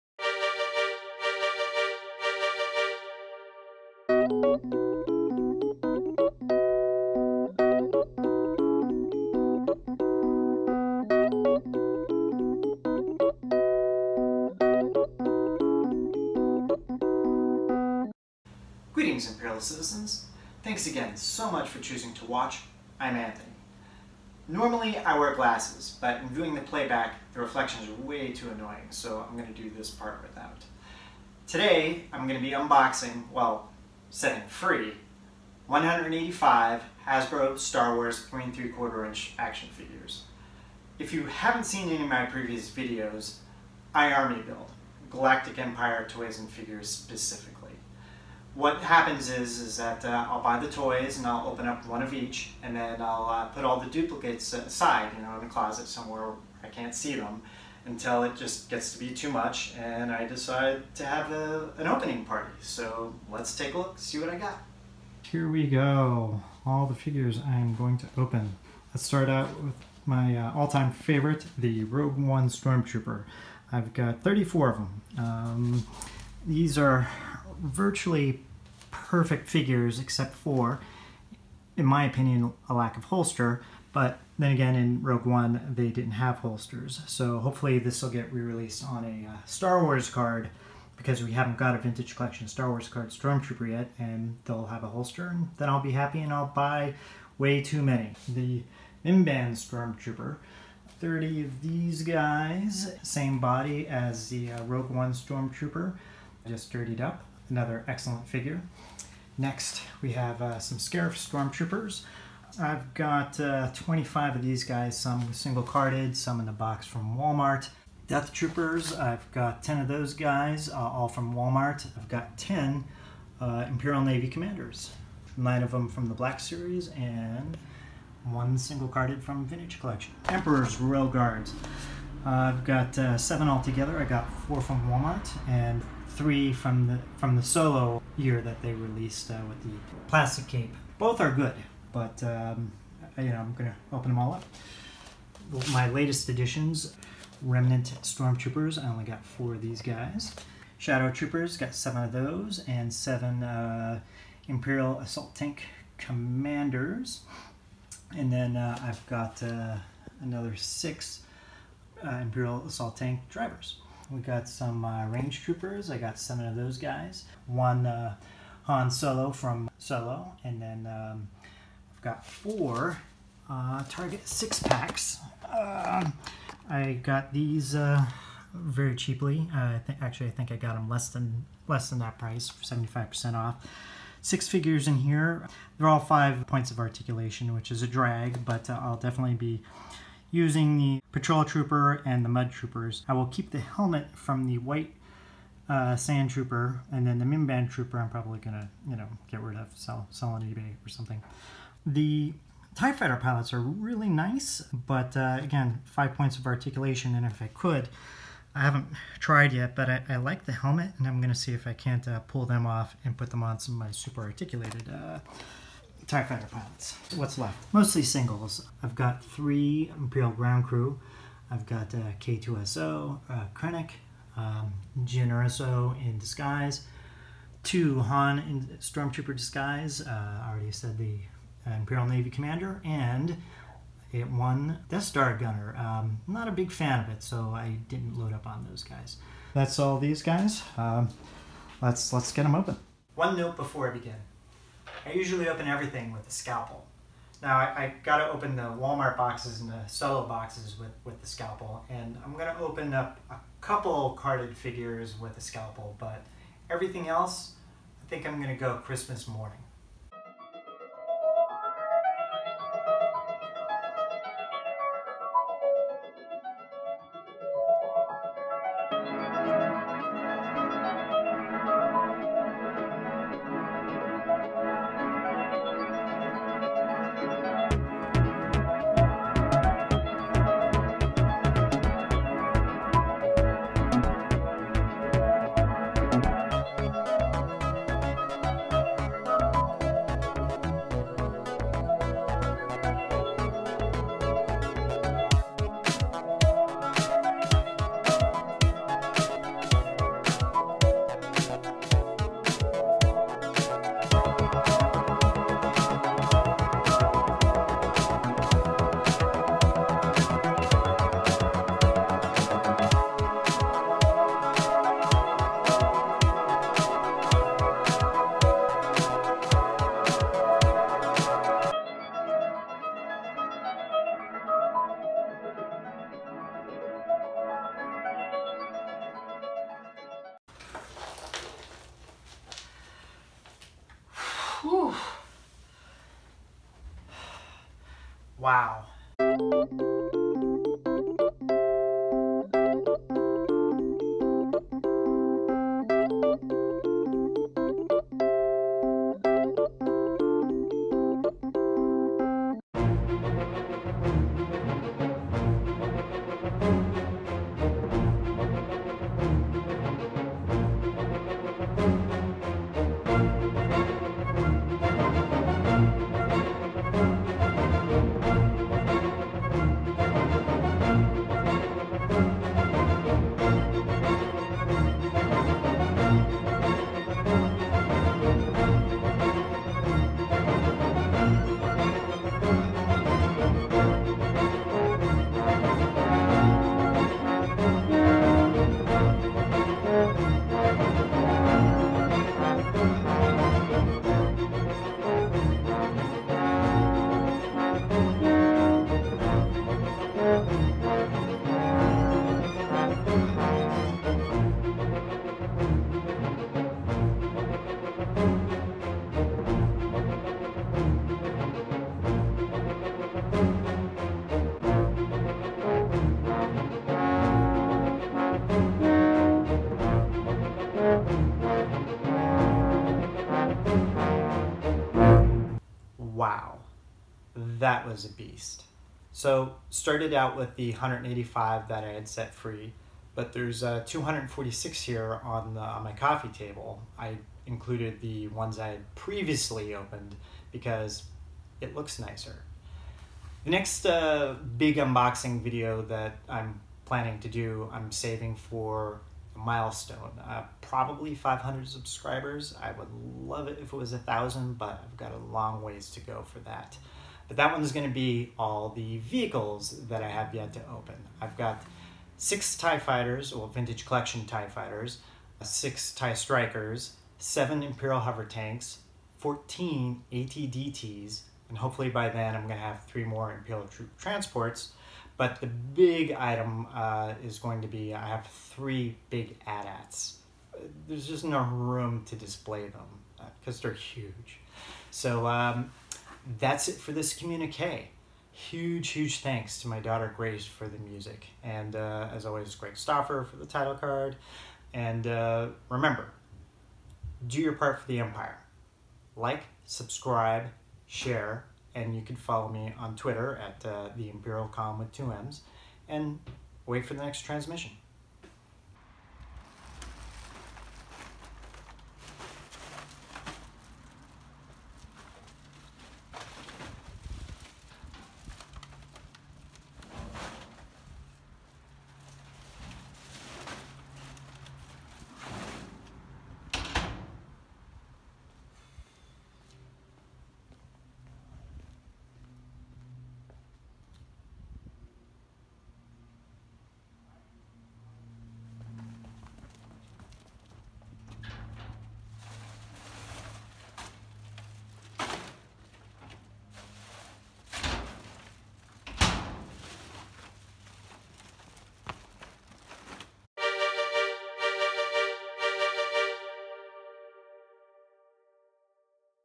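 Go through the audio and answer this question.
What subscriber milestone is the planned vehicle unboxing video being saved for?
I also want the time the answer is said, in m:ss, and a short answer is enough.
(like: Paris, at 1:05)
500, at 7:31.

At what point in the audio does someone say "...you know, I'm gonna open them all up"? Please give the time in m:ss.
2:23.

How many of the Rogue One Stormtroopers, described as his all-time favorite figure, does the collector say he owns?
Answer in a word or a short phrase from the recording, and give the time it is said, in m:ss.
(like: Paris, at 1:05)
34, at 1:14.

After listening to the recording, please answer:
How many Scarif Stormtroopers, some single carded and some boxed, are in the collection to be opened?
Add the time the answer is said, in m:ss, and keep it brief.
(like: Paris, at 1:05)
25, at 1:53.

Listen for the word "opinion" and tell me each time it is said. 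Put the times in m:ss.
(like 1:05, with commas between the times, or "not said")
1:22.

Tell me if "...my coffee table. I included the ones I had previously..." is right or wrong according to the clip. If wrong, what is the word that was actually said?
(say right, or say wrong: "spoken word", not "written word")
right.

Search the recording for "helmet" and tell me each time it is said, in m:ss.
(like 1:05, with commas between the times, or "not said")
3:13, 3:30.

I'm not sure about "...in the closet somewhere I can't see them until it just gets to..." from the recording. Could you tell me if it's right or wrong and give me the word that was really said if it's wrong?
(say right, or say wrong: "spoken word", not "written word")
right.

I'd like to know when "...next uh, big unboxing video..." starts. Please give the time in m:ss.
7:23.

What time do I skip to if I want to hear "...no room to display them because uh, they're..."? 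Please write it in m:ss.
8:01.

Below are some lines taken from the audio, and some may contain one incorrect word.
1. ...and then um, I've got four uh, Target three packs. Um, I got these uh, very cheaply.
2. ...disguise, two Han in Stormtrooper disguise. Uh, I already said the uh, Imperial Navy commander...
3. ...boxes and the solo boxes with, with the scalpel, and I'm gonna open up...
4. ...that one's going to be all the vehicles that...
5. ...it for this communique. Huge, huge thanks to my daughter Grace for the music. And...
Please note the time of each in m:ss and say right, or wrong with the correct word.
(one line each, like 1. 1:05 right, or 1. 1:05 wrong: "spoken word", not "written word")
1. 2:50 wrong: "six", not "three"
2. 3:46 right
3. 4:09 right
4. 7:37 right
5. 8:06 right.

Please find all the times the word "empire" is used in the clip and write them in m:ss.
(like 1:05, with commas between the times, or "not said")
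0:45, 8:17.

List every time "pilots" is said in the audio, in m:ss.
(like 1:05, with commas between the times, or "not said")
3:23, 3:36.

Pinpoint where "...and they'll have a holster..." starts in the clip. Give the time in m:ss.
1:33.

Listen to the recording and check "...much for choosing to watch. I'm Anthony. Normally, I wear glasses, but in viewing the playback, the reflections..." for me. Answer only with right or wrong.
right.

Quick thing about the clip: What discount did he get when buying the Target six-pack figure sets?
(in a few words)
75%.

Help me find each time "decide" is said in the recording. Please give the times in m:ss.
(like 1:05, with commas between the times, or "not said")
1:00.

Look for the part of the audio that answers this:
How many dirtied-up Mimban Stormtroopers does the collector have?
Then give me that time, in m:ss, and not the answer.
1:40.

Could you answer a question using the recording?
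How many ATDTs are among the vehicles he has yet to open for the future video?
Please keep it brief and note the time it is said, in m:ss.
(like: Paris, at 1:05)
14, at 7:49.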